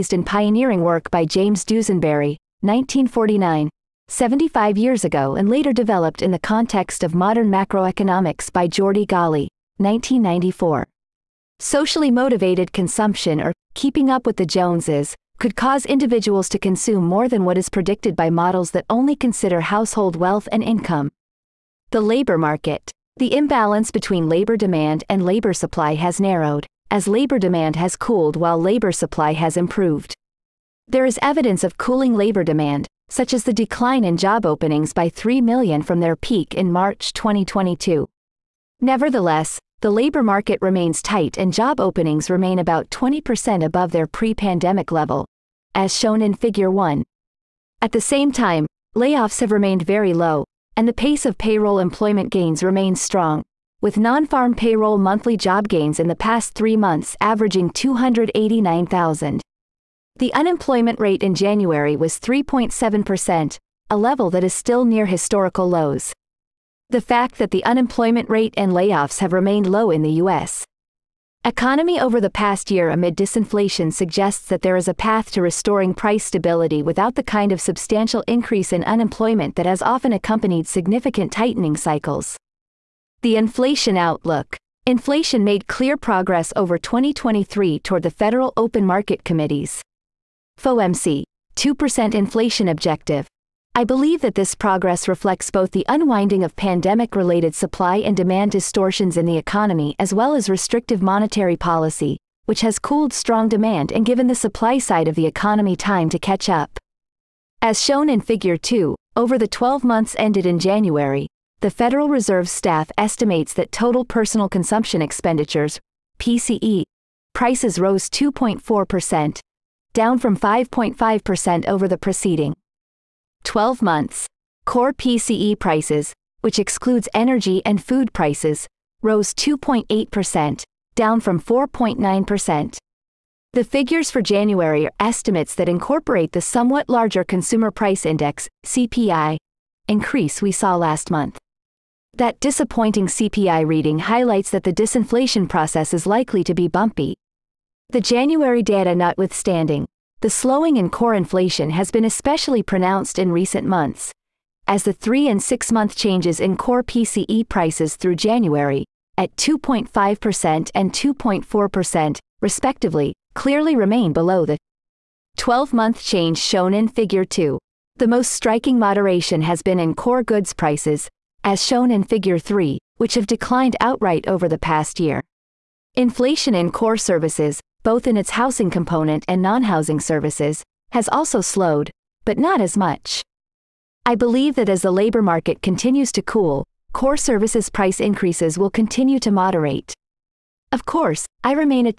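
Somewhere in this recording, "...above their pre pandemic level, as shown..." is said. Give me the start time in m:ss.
0:43.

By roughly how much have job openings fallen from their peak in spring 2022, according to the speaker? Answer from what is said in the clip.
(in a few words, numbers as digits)
3 million.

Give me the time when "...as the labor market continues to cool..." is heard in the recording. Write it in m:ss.
3:04.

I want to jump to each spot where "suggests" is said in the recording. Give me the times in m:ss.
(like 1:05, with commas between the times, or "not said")
1:13.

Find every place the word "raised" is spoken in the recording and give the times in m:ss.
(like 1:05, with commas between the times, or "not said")
not said.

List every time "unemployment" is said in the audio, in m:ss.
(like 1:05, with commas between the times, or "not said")
1:00, 1:07, 1:18.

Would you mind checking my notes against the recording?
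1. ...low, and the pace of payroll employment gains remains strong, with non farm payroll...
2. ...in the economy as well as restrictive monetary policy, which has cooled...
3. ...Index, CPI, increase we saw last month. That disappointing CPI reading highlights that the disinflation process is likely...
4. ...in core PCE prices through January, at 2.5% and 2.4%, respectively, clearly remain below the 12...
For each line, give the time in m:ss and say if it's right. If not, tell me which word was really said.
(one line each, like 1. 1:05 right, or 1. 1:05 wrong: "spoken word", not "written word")
1. 0:50 right
2. 1:39 right
3. 2:18 right
4. 2:36 right.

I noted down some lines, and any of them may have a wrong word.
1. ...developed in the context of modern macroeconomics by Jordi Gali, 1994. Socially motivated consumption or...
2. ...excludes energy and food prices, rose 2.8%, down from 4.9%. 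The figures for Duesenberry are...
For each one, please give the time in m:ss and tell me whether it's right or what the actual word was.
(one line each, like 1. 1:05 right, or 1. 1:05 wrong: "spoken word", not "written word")
1. 0:05 right
2. 2:06 wrong: "January", not "Duesenberry".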